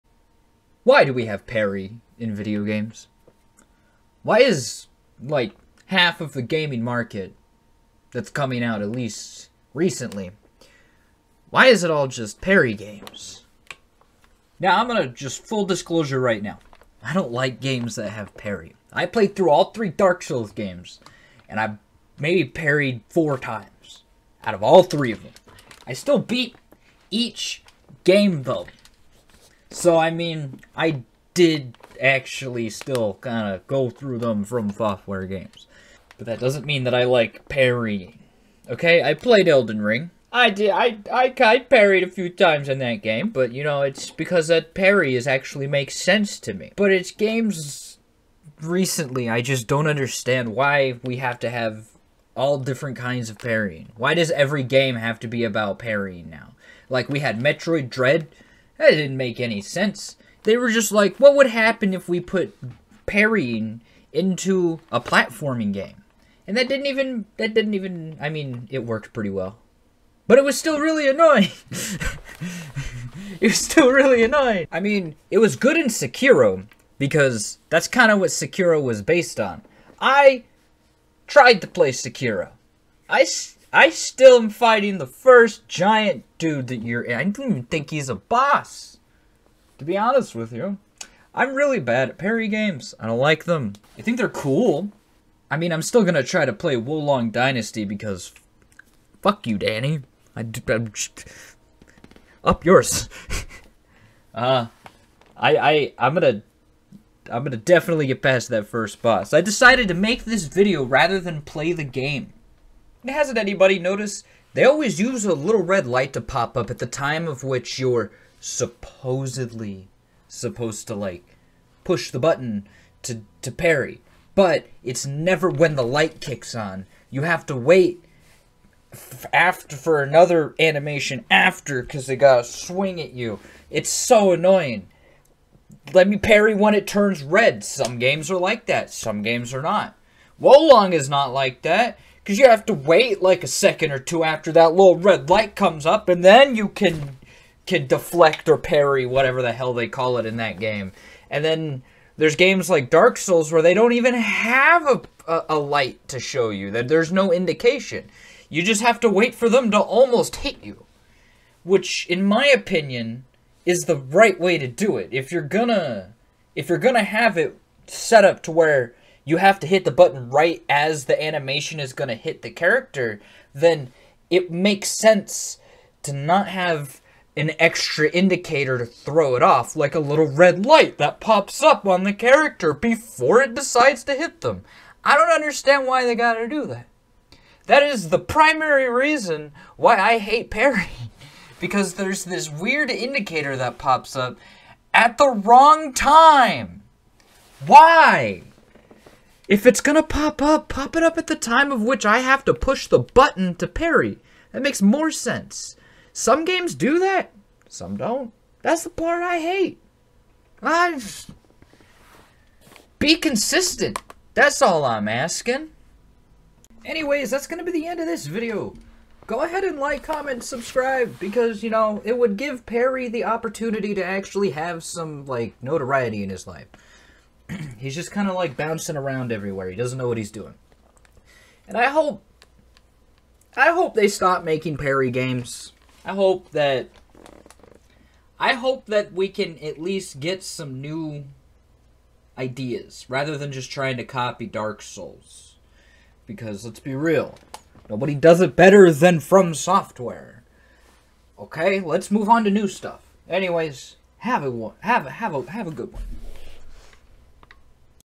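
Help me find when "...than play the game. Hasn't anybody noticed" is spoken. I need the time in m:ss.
1:51.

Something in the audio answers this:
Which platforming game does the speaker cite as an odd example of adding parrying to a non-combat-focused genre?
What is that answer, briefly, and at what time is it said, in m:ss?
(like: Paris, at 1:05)
Metroid Dread, at 0:57.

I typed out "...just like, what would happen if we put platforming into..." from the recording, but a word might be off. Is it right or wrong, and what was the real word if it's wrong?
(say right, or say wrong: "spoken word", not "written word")
wrong: "parrying", not "platforming".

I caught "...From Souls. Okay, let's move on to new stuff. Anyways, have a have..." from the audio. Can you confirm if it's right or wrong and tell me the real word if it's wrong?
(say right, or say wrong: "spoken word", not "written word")
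wrong: "Software", not "Souls".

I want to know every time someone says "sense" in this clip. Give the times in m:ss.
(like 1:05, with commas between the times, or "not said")
0:45, 0:59, 2:54, 3:25.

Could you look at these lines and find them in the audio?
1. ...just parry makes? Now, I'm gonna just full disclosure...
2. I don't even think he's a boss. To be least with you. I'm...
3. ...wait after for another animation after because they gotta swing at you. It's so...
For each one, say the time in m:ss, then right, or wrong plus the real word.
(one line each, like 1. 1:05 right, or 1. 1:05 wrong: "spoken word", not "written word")
1. 0:12 wrong: "games", not "makes"
2. 1:27 wrong: "honest", not "least"
3. 2:07 right.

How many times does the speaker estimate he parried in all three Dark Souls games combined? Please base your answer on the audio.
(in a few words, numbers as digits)
4.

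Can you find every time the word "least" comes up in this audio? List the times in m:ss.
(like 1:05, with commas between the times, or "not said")
0:08, 3:59.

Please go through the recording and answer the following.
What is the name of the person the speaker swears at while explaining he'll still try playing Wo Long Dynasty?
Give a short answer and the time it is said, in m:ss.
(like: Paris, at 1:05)
Danny, at 1:39.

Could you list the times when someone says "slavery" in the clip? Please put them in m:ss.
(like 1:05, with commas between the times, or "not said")
not said.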